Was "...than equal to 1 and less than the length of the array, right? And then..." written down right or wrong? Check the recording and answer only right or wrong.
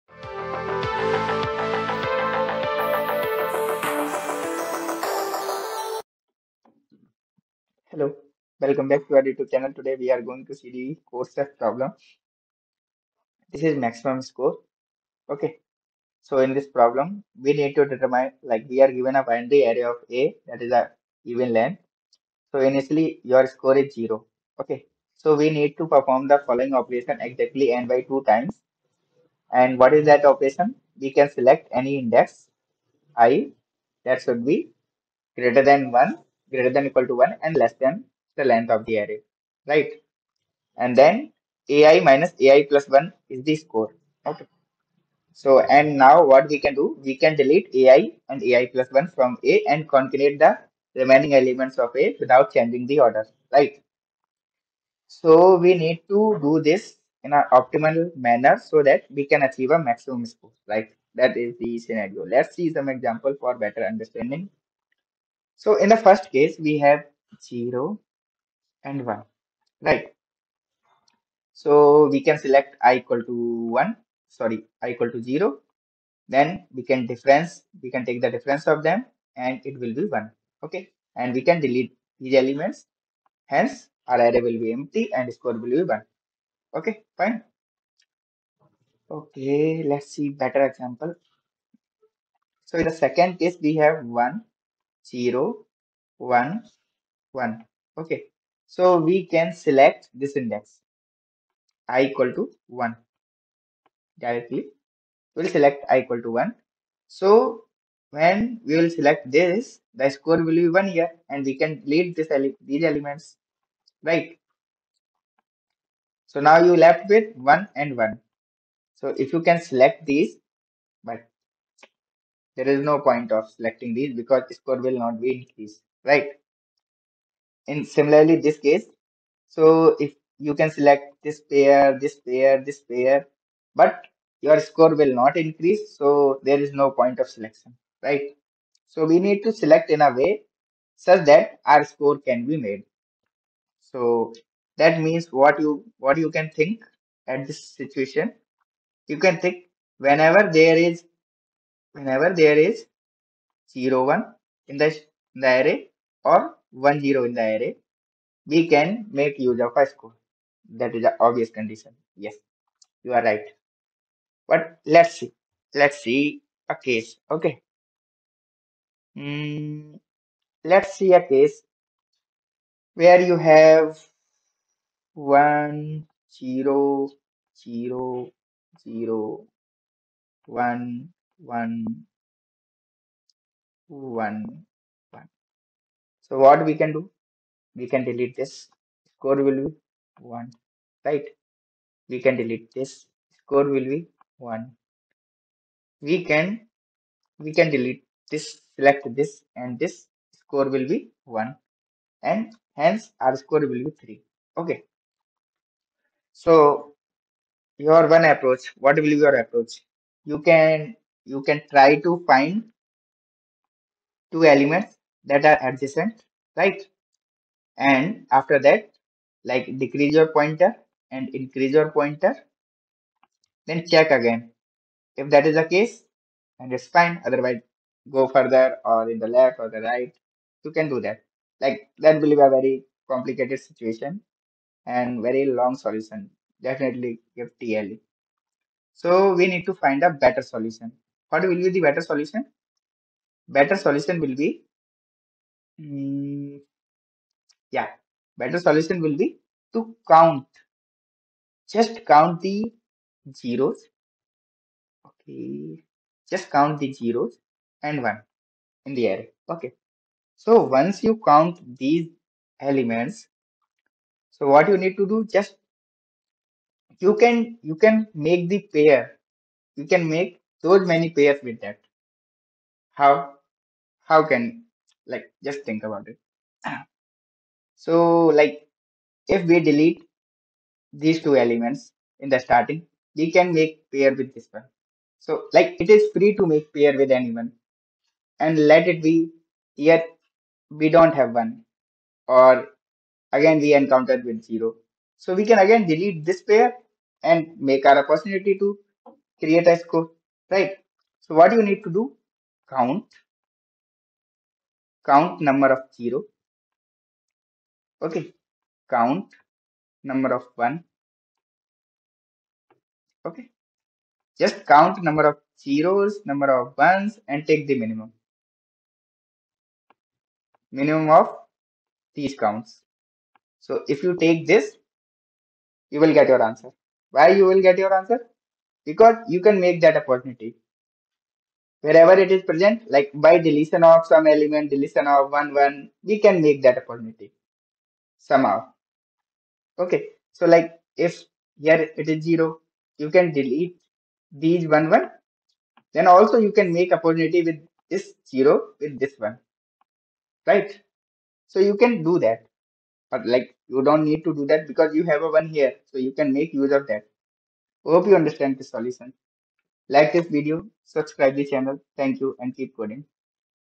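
right.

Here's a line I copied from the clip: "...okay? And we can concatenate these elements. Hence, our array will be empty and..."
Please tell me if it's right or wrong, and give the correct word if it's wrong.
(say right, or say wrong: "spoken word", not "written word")
wrong: "delete", not "concatenate".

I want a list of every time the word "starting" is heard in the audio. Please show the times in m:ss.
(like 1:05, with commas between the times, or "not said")
4:42.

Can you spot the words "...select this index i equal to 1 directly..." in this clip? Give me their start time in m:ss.
1:39.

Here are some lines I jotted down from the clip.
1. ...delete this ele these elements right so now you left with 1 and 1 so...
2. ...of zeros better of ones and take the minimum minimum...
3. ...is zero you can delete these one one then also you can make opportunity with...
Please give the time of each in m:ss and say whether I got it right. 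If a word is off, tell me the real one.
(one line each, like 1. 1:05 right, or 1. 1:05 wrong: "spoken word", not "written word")
1. 1:51 right
2. 5:15 wrong: "number", not "better"
3. 5:42 right.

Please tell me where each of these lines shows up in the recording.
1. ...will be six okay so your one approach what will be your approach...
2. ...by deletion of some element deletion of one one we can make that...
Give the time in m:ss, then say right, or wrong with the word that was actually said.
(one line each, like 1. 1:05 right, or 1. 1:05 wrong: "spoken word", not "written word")
1. 3:23 wrong: "three", not "six"
2. 5:33 right.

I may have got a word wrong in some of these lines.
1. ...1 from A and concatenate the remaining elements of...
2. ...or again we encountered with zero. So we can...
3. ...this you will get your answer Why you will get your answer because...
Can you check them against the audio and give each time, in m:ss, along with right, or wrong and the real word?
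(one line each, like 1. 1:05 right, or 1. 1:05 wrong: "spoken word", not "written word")
1. 0:48 right
2. 4:52 right
3. 5:24 right.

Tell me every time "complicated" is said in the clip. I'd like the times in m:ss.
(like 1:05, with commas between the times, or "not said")
3:53.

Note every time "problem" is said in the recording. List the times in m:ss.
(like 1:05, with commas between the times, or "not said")
0:11, 0:16.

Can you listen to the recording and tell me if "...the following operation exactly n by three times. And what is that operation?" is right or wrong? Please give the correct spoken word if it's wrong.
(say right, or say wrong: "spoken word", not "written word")
wrong: "two", not "three".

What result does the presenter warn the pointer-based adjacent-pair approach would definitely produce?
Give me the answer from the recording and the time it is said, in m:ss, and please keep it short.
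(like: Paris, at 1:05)
TLE, at 3:56.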